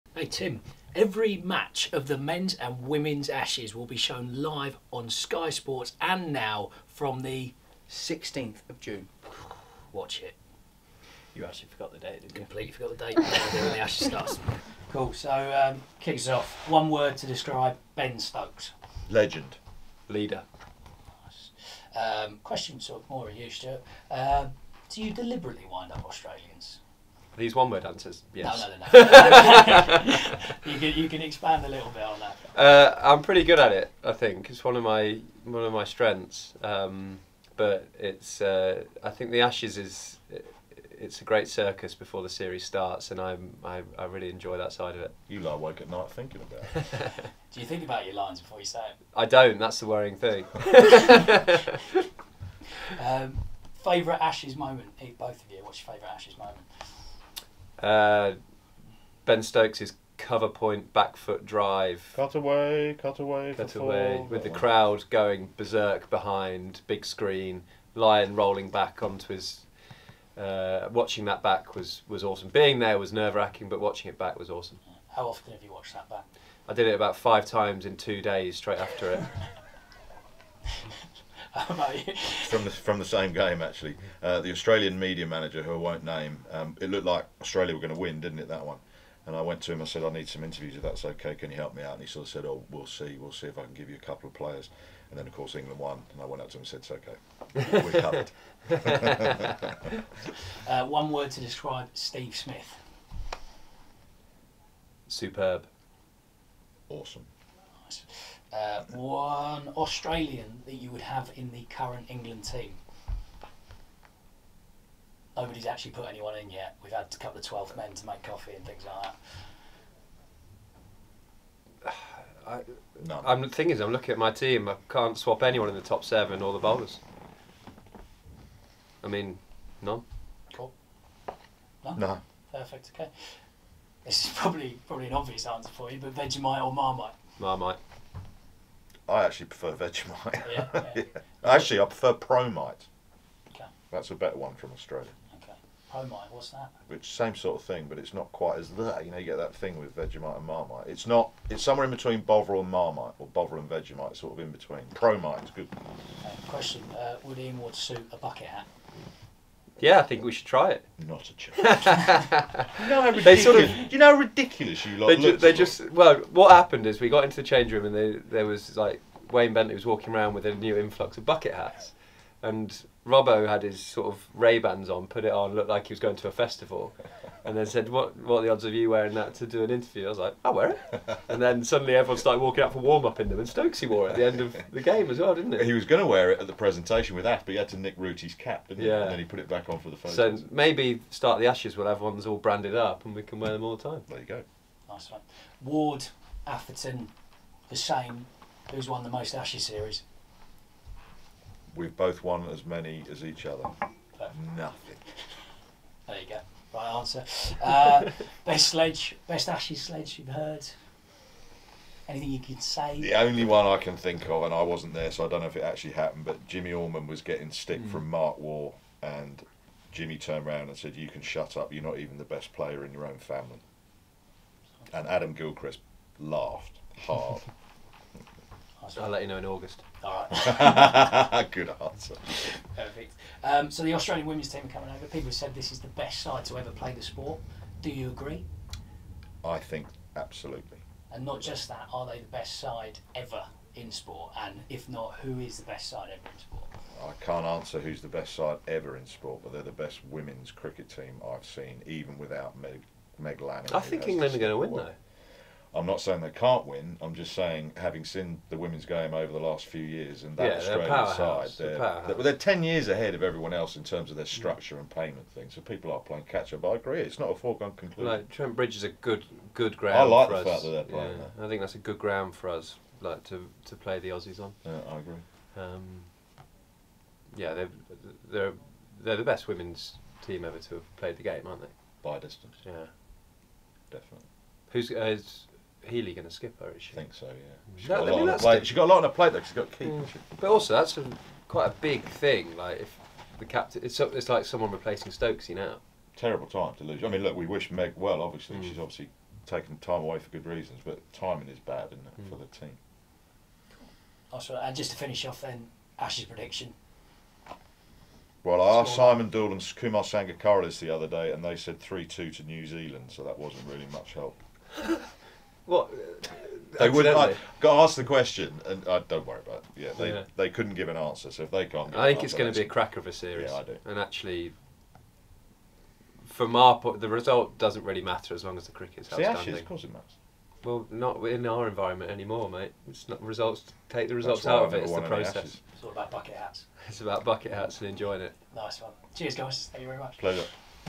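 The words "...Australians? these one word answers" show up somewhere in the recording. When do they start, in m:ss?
0:26.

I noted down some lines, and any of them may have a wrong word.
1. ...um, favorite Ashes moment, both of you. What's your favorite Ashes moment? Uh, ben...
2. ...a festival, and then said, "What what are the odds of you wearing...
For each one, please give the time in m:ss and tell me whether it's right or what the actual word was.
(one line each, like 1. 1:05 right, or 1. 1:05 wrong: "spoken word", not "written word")
1. 0:53 right
2. 2:56 right.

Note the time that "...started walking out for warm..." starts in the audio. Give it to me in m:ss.
3:02.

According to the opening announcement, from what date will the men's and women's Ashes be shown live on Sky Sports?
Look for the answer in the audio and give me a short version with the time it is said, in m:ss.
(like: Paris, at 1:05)
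16th of June, at 0:07.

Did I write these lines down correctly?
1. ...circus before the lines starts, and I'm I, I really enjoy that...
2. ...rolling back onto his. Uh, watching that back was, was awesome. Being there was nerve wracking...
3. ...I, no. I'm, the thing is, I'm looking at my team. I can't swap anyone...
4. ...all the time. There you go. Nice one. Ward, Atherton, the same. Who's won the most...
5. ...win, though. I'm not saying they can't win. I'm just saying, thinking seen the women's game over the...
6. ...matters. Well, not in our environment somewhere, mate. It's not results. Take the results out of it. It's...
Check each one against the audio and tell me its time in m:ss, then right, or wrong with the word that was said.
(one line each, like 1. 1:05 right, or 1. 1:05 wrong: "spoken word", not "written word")
1. 0:41 wrong: "series", not "lines"
2. 1:08 right
3. 2:02 right
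4. 3:13 right
5. 4:14 wrong: "having", not "thinking"
6. 5:29 wrong: "anymore", not "somewhere".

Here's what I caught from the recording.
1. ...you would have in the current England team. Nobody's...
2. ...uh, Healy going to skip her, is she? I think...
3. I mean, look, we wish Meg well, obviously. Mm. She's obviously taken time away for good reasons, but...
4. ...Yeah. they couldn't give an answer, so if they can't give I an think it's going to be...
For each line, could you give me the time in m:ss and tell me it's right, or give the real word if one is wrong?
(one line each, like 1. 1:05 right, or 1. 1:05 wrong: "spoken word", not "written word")
1. 1:50 right
2. 4:44 right
3. 4:57 right
4. 5:20 right.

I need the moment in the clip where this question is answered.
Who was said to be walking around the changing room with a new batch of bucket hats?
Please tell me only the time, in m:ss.
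2:49.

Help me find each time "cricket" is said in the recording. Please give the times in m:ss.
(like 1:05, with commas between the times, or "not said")
4:10, 5:28.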